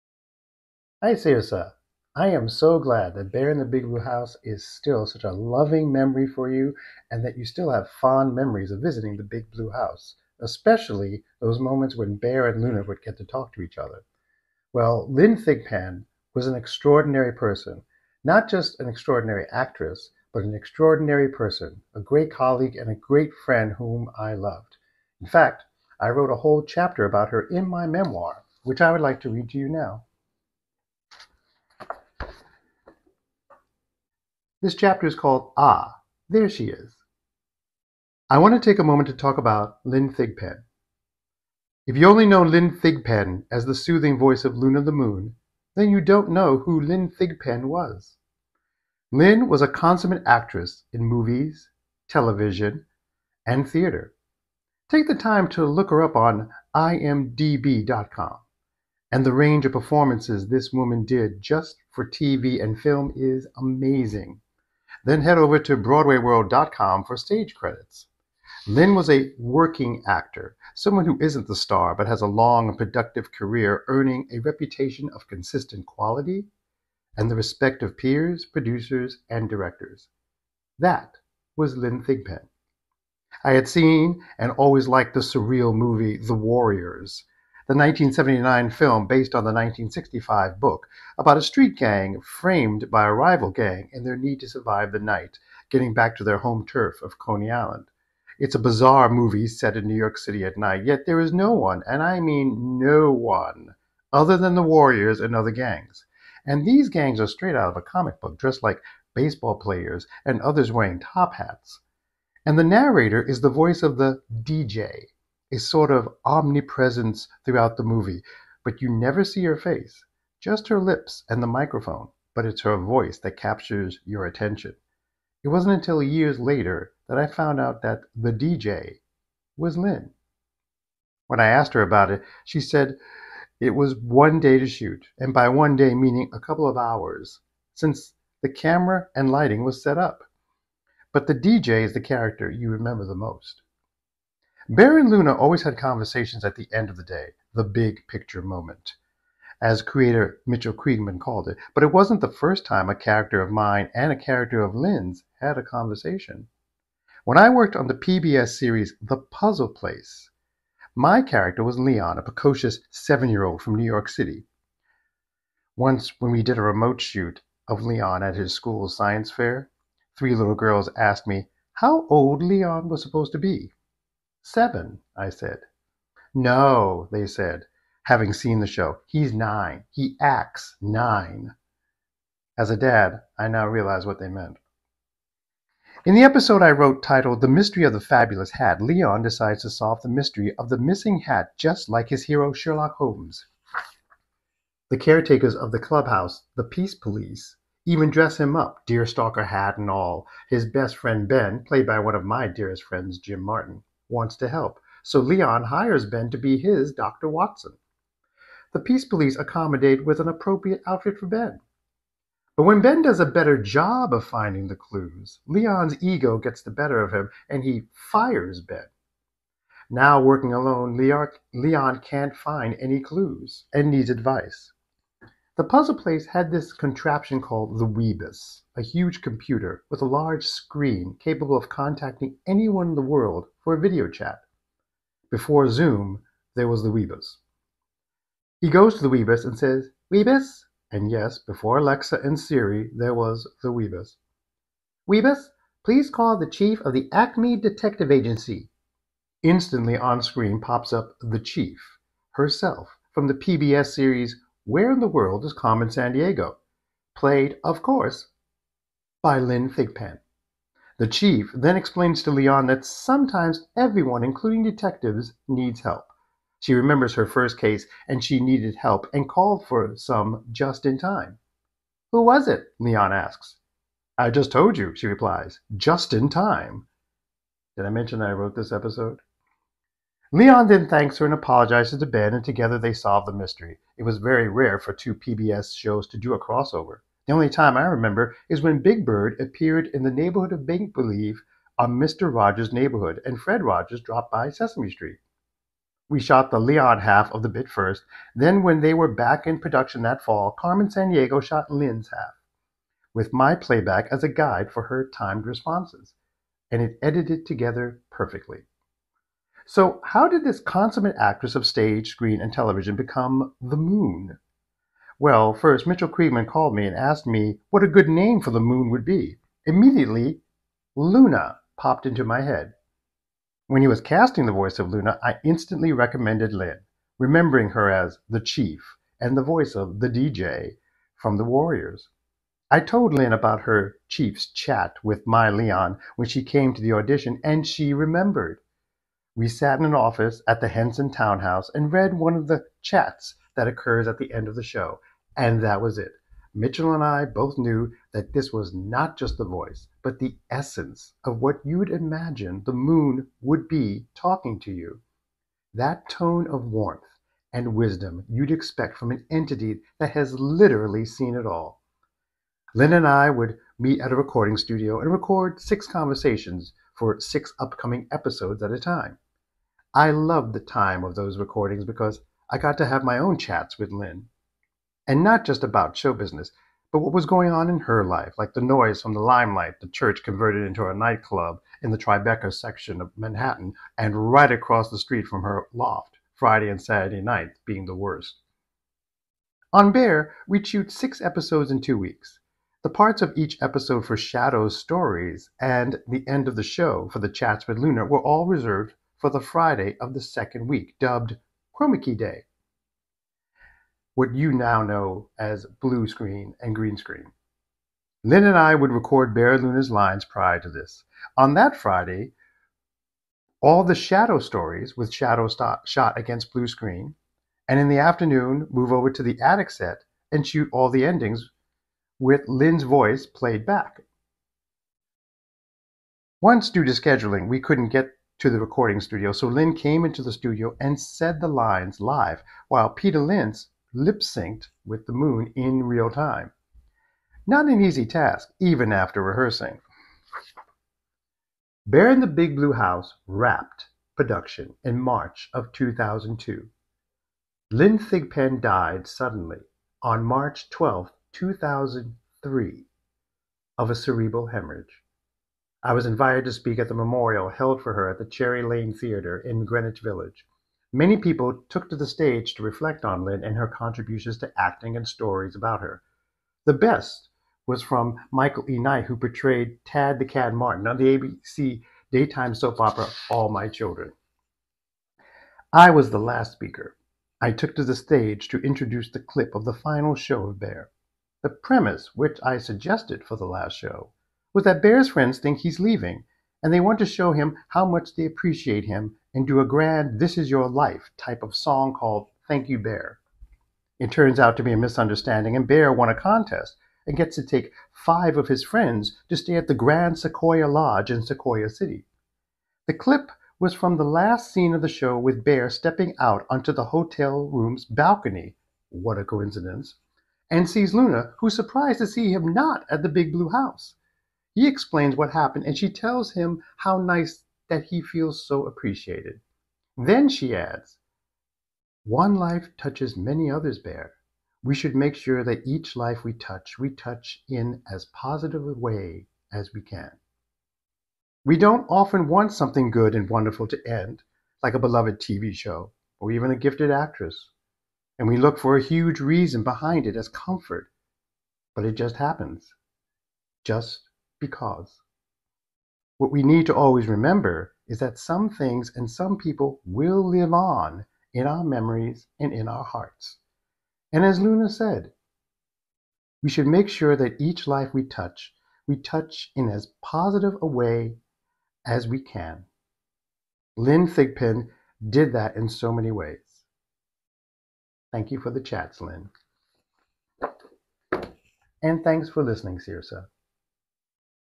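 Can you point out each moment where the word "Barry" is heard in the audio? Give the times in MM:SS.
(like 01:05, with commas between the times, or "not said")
06:49.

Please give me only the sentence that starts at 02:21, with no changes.
But the DJ is the character you remember the most.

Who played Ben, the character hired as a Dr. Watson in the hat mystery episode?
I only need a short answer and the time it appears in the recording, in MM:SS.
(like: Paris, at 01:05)
Jim Martin, at 03:23.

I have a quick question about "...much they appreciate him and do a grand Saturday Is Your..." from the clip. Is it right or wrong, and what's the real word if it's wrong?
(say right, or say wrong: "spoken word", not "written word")
wrong: "This", not "Saturday".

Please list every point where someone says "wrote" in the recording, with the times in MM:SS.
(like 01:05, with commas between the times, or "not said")
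00:26, 03:06, 04:38.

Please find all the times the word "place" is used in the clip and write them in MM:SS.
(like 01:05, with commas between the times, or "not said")
02:39, 03:45.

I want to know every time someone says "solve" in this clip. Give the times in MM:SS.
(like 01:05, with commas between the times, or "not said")
03:09, 04:42.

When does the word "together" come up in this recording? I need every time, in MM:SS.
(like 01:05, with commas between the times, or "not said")
04:42, 05:07.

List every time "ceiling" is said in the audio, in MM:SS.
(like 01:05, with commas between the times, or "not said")
not said.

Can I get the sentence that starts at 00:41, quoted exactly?
If you only know Lynne Thigpen as the soothing voice of Luna the Moon, then you don't know who Lynne Thigpen was.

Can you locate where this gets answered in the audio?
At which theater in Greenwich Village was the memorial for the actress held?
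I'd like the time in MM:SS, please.
07:38.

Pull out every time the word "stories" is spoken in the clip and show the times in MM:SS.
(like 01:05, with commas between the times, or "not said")
06:34, 06:54, 07:45.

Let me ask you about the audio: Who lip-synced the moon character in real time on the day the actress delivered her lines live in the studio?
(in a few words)
Peter Linz.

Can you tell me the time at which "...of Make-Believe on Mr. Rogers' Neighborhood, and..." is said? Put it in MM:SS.
04:50.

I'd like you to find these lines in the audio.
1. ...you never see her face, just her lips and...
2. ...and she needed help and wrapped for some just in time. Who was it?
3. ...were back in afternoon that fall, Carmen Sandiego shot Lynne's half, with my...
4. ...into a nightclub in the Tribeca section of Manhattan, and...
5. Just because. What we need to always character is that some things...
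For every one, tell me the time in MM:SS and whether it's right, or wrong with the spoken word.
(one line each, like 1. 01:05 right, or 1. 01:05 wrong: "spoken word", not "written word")
1. 01:58 right
2. 04:28 wrong: "called", not "wrapped"
3. 04:58 wrong: "production", not "afternoon"
4. 06:20 right
5. 09:03 wrong: "remember", not "character".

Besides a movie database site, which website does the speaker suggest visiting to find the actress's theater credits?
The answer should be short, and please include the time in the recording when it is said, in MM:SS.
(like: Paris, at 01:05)
BroadwayWorld.com, at 01:05.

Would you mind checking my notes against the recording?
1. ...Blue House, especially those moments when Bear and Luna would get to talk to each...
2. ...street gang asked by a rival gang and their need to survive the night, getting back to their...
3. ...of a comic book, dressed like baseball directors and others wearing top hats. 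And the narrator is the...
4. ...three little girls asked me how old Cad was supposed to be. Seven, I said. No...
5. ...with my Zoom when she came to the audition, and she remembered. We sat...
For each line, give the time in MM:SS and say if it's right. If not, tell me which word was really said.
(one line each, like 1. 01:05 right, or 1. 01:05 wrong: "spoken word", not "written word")
1. 00:09 right
2. 01:31 wrong: "framed", not "asked"
3. 01:47 wrong: "players", not "directors"
4. 02:50 wrong: "Leon", not "Cad"
5. 05:35 wrong: "Leon", not "Zoom".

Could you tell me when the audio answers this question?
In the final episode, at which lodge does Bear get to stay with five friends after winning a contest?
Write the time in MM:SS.
08:19.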